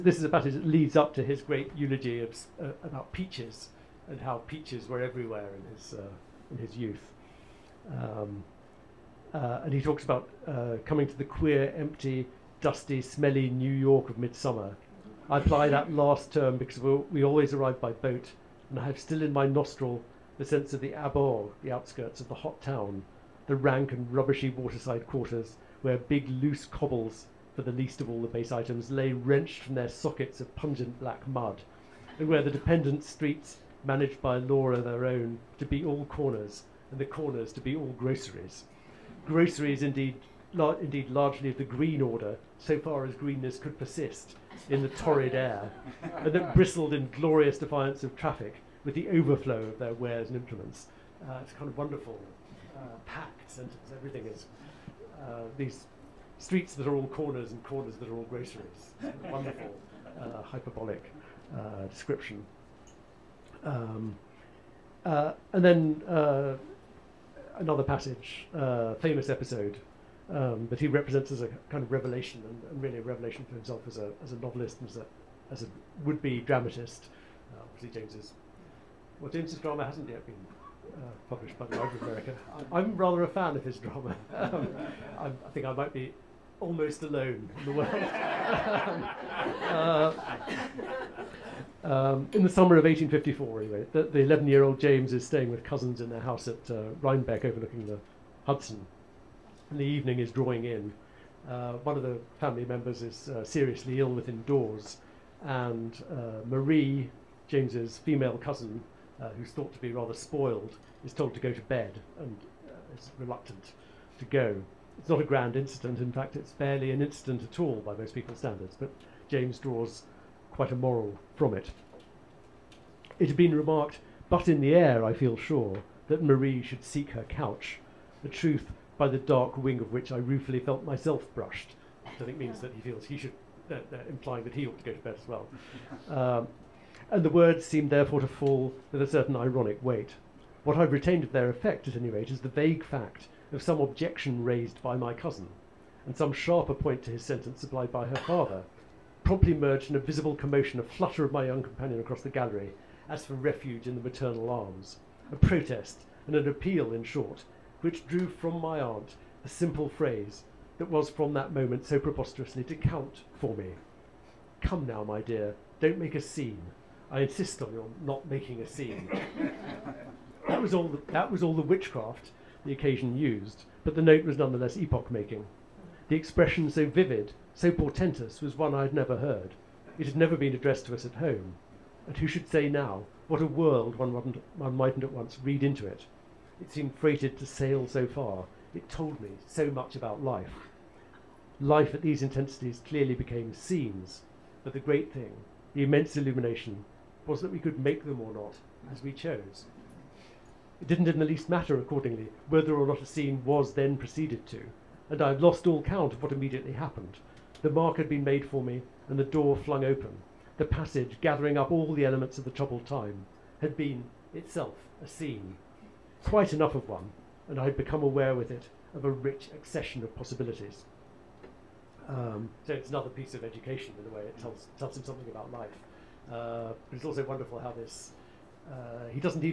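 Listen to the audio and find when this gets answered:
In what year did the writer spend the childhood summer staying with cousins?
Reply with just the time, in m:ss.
1:32.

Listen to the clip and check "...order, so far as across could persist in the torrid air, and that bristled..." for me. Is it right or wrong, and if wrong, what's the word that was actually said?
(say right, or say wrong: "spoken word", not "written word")
wrong: "greenness", not "across".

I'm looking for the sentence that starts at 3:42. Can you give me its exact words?
Um, so it's another piece of education in a way.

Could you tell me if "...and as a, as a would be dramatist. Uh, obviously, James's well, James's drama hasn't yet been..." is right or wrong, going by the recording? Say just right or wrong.
right.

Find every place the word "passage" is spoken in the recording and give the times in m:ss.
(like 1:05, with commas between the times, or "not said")
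1:07, 3:30.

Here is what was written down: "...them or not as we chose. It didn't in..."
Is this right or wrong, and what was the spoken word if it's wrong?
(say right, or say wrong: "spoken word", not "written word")
right.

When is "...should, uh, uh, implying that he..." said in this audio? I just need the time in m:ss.
2:13.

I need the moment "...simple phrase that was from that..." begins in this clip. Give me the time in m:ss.
2:39.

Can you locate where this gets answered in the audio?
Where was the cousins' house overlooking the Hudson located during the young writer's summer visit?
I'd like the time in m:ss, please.
1:36.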